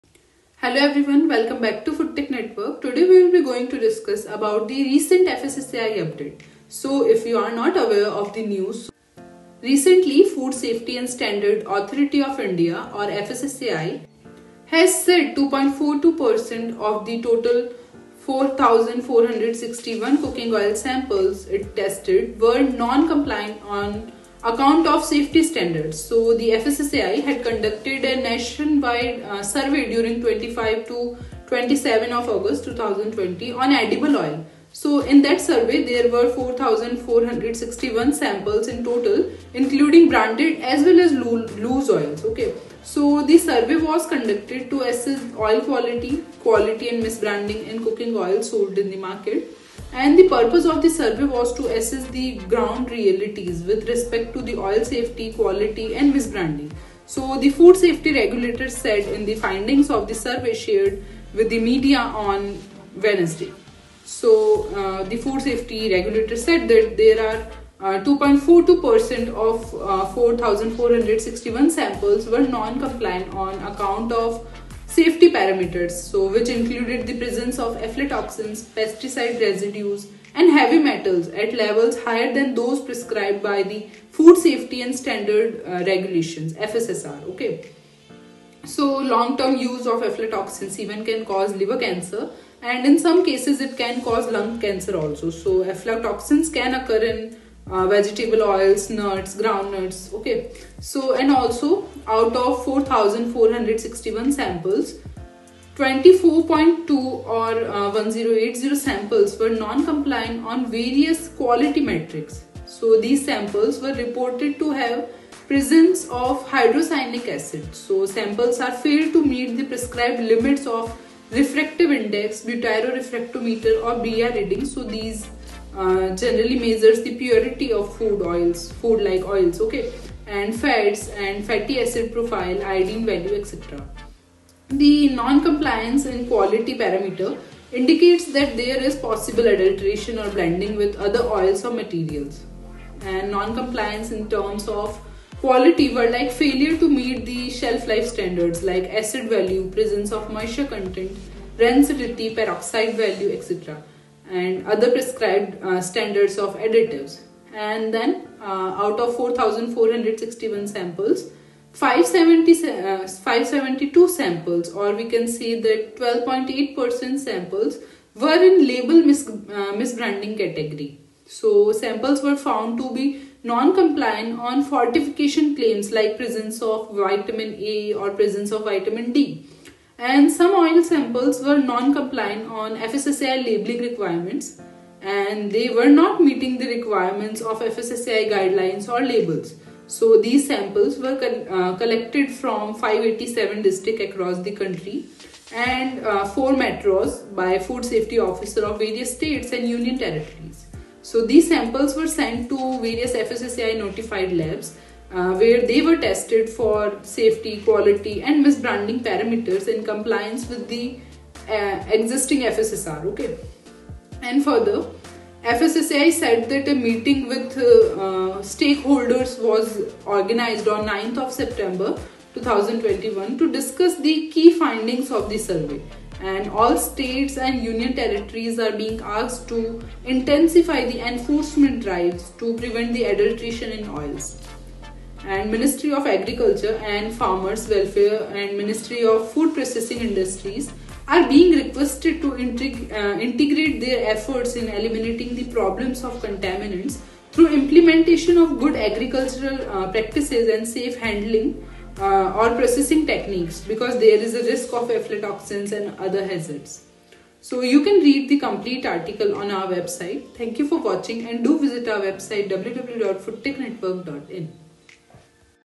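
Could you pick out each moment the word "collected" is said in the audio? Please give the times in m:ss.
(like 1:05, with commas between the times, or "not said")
3:11.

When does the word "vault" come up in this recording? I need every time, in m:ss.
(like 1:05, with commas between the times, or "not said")
not said.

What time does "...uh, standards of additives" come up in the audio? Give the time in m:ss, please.
2:35.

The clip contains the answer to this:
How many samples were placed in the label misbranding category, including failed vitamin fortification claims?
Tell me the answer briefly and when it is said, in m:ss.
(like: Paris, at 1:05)
572, at 2:41.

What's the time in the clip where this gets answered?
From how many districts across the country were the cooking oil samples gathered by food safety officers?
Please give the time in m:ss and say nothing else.
3:12.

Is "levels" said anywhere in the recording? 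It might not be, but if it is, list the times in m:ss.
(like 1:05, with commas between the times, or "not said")
1:21.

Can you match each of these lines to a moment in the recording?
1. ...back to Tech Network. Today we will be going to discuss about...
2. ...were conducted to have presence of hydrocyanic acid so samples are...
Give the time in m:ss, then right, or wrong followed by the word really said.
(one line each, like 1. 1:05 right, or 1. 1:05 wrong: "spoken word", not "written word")
1. 0:01 right
2. 1:53 wrong: "reported", not "conducted".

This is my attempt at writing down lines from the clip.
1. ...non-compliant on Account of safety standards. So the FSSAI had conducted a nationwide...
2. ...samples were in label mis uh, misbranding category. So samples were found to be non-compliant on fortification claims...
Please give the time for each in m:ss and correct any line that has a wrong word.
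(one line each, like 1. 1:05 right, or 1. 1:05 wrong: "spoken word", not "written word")
1. 0:22 right
2. 2:47 right.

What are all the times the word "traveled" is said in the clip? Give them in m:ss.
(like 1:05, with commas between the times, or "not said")
not said.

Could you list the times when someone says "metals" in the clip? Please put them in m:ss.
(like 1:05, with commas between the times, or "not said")
1:20.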